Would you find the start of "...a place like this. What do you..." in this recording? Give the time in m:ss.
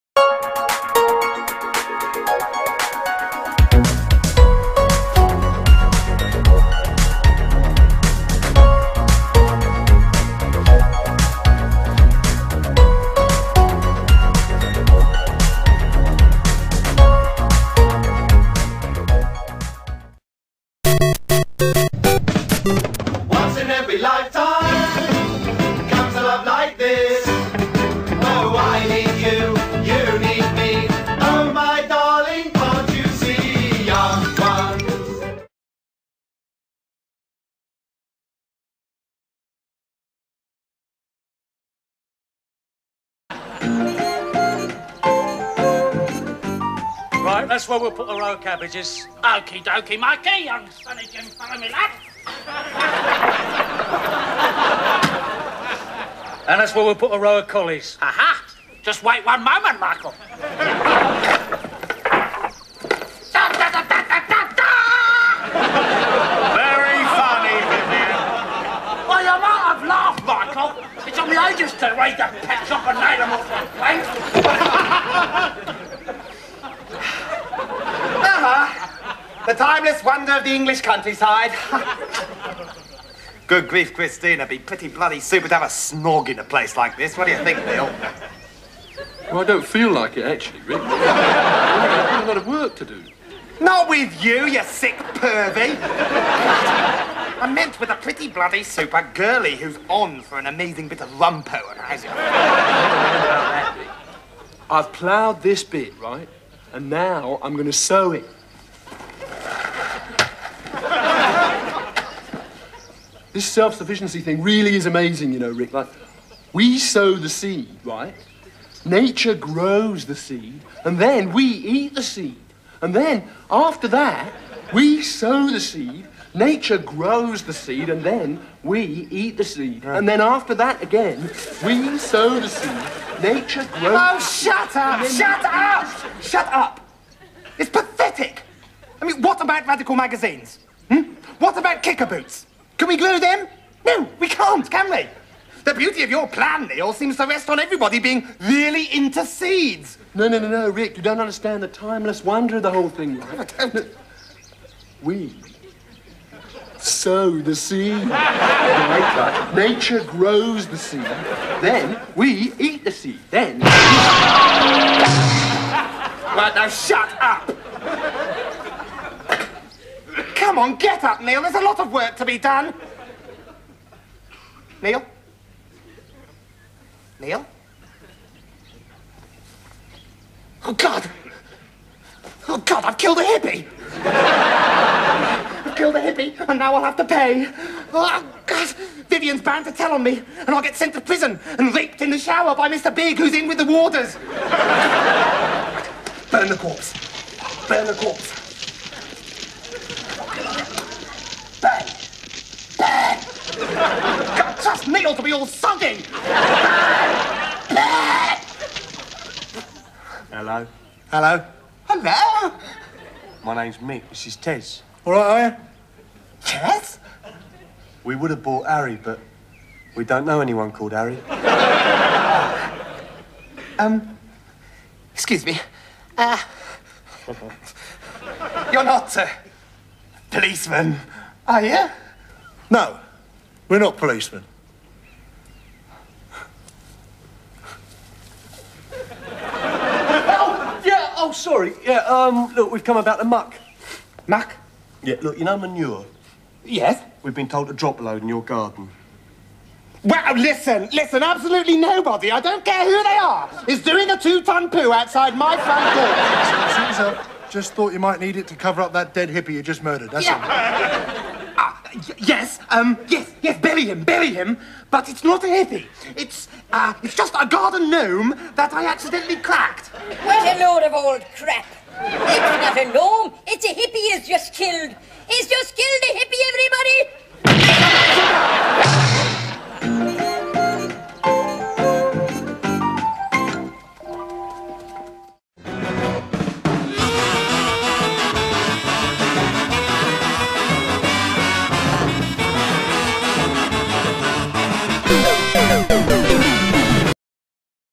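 1:26.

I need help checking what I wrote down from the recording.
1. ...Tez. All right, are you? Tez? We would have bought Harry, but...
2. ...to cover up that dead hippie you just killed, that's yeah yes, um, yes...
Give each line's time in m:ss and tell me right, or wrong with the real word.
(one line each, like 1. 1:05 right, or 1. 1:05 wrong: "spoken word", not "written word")
1. 3:34 right
2. 4:18 wrong: "murdered", not "killed".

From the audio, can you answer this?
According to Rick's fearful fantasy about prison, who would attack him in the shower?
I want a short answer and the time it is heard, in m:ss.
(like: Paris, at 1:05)
Mr. Big, at 3:12.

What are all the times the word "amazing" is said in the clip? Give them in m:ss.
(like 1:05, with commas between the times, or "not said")
1:40, 1:54.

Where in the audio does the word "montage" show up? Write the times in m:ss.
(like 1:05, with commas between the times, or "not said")
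not said.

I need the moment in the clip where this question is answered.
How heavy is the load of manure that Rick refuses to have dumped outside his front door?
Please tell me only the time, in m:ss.
4:14.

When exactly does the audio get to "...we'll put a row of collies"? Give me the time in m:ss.
0:56.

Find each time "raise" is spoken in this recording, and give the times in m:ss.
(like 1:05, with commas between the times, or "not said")
1:11.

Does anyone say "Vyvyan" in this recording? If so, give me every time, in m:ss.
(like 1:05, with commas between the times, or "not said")
1:07, 3:09.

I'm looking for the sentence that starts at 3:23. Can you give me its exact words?
Got just nailed to be all soggy.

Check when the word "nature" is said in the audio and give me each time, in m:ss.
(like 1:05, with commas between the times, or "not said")
1:58, 2:06, 2:13, 2:39.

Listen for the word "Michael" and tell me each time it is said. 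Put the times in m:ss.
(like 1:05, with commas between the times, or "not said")
0:59, 1:10.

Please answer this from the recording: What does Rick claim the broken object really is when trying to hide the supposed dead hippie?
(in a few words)
garden gnome.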